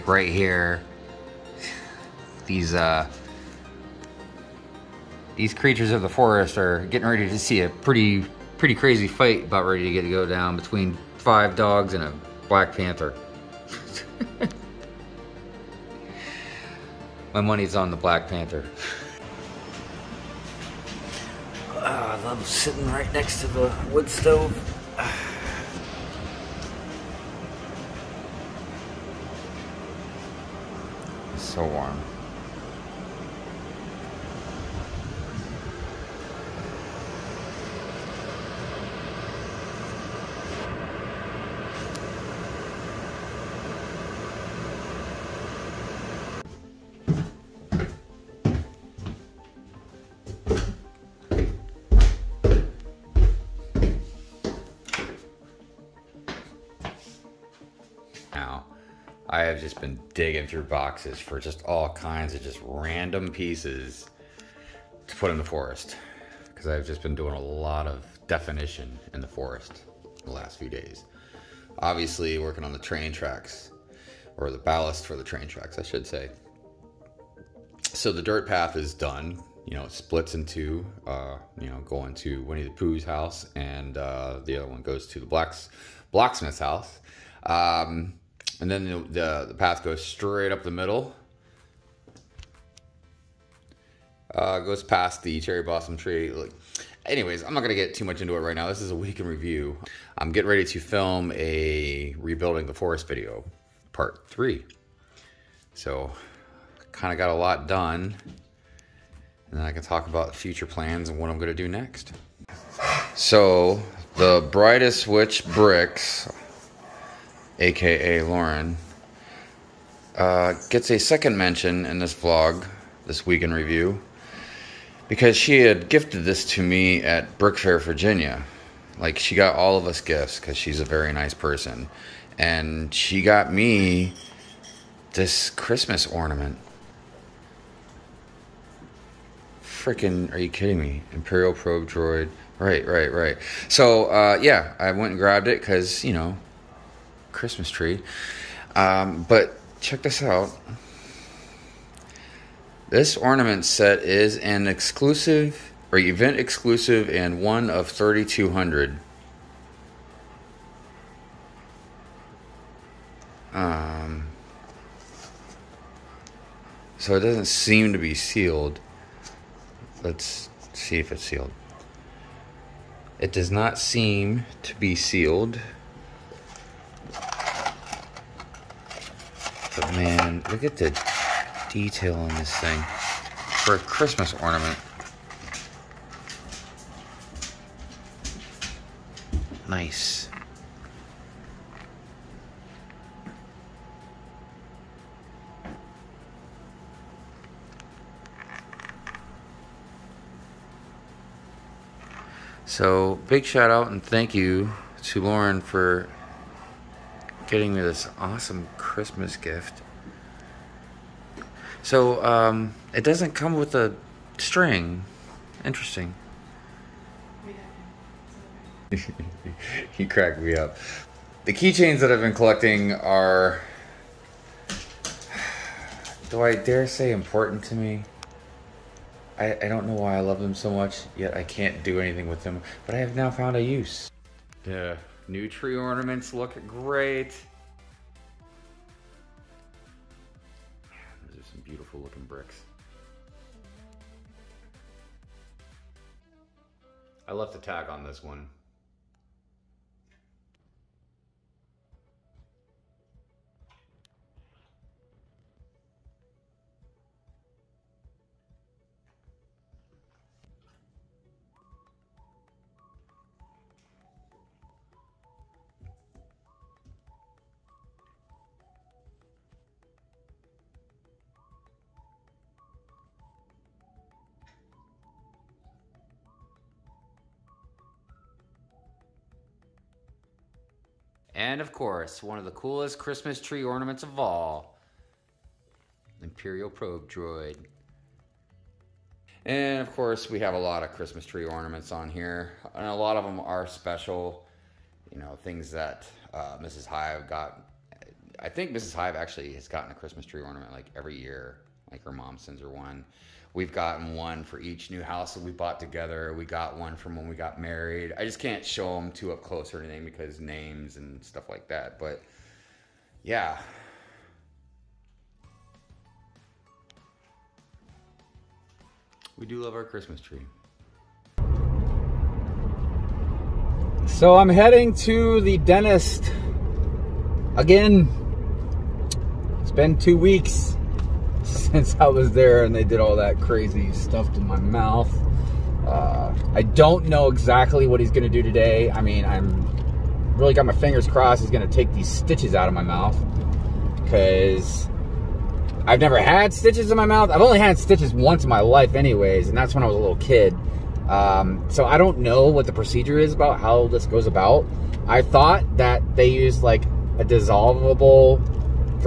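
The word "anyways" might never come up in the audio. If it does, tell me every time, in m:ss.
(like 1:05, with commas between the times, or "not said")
1:37, 5:48.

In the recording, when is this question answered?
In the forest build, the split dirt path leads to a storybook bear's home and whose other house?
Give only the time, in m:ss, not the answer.
1:26.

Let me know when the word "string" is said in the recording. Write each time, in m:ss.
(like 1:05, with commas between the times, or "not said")
3:34.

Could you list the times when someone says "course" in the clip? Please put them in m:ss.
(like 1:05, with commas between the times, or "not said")
4:41, 4:49.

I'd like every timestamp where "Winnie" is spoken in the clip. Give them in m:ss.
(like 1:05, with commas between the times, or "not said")
1:22.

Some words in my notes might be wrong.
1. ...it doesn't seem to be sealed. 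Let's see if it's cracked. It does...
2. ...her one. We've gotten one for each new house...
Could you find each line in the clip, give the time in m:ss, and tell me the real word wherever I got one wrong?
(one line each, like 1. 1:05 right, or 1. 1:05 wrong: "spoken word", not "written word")
1. 2:47 wrong: "sealed", not "cracked"
2. 5:02 right.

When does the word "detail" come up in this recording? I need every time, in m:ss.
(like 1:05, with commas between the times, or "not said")
3:01.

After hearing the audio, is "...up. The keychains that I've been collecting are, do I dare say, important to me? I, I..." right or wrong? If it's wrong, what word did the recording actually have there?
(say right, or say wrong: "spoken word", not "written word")
right.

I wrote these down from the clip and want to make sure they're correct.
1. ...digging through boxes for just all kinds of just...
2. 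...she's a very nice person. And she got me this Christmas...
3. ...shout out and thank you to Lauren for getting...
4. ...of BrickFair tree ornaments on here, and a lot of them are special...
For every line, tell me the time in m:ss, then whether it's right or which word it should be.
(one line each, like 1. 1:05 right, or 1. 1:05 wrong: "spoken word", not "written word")
1. 1:00 right
2. 2:10 right
3. 3:23 right
4. 4:50 wrong: "Christmas", not "BrickFair".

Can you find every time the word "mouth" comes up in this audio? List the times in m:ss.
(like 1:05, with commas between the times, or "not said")
5:34, 5:42, 5:47.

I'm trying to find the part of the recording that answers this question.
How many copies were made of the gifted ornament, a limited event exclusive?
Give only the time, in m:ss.
2:37.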